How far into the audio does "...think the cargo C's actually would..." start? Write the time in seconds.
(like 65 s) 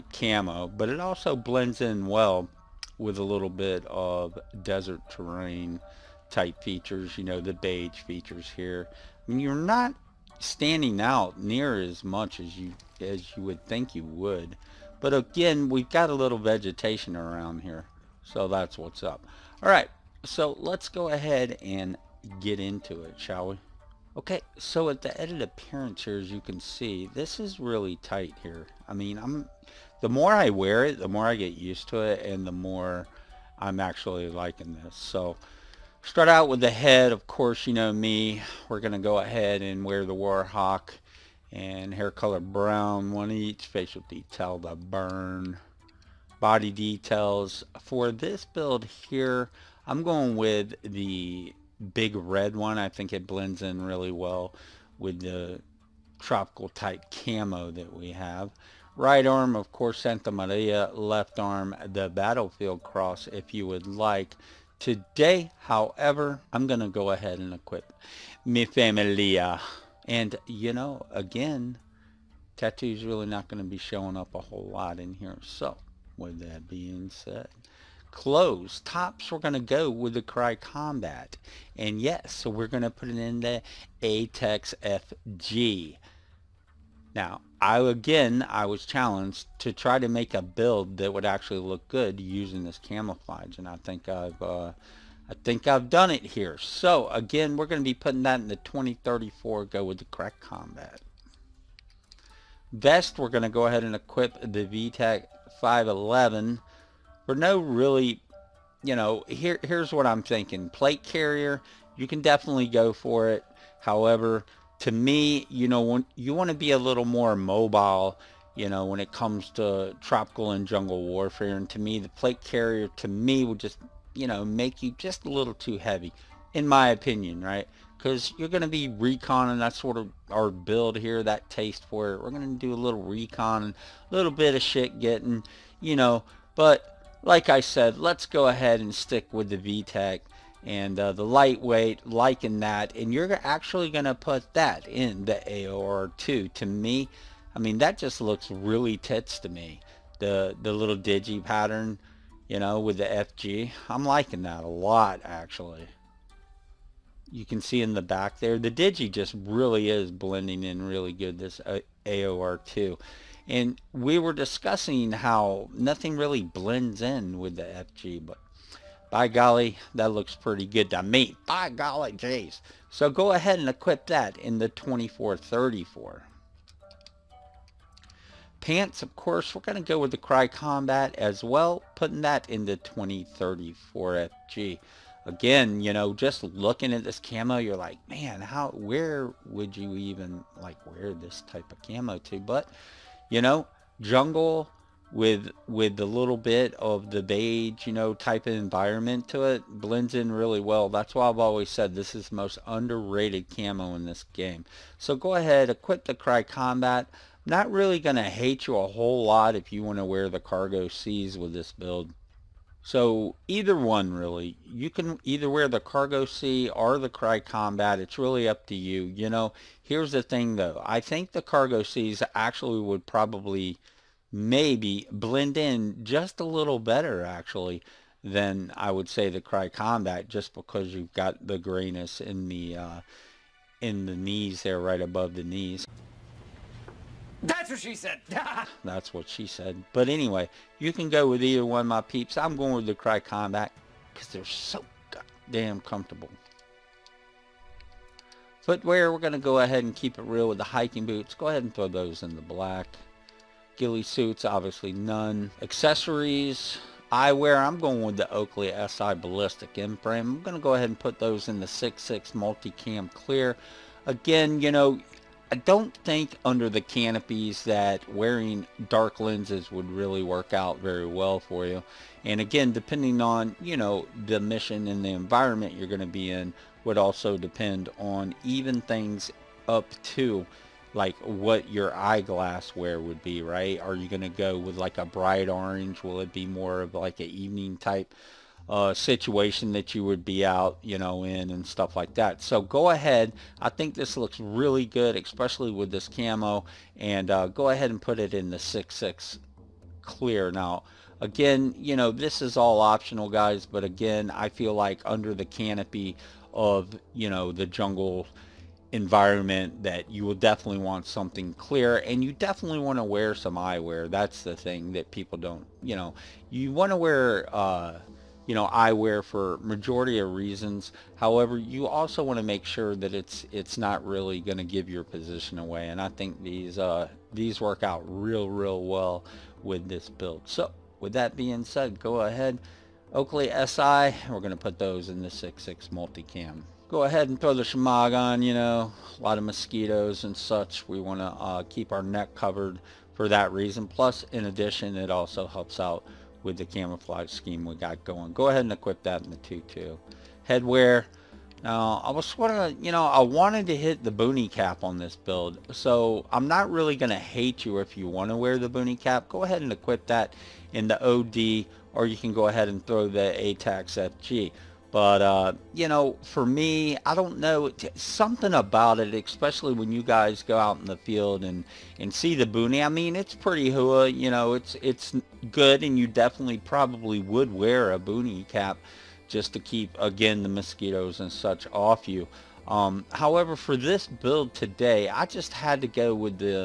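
221 s.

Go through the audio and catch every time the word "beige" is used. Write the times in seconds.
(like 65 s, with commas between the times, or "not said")
7 s, 197 s.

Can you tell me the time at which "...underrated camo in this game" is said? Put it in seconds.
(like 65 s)
202 s.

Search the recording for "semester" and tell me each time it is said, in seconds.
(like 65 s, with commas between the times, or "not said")
not said.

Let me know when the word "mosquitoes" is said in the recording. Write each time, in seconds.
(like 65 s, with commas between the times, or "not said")
339 s, 380 s.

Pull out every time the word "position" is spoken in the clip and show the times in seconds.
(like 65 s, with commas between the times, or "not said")
325 s.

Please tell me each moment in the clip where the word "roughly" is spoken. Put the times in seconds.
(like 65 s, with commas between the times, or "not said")
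not said.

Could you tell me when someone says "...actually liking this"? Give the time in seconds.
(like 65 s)
33 s.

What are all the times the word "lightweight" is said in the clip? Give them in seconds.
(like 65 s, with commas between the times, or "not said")
141 s.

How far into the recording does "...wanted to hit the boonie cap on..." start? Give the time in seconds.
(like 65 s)
353 s.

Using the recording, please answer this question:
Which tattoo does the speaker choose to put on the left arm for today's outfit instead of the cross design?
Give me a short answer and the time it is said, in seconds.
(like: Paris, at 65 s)
Mi Familia, at 68 s.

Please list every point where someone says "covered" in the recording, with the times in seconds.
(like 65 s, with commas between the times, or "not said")
342 s.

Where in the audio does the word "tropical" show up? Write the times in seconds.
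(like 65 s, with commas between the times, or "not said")
56 s, 120 s.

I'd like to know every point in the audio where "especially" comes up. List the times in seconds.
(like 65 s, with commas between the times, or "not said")
295 s, 369 s.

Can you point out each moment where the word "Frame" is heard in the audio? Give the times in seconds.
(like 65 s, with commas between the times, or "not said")
259 s.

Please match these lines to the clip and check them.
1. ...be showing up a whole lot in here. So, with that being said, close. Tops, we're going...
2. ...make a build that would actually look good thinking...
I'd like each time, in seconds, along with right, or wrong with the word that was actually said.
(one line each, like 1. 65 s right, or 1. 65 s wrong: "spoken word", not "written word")
1. 73 s right
2. 90 s wrong: "using", not "thinking".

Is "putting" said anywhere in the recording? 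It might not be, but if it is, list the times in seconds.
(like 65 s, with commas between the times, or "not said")
97 s, 181 s.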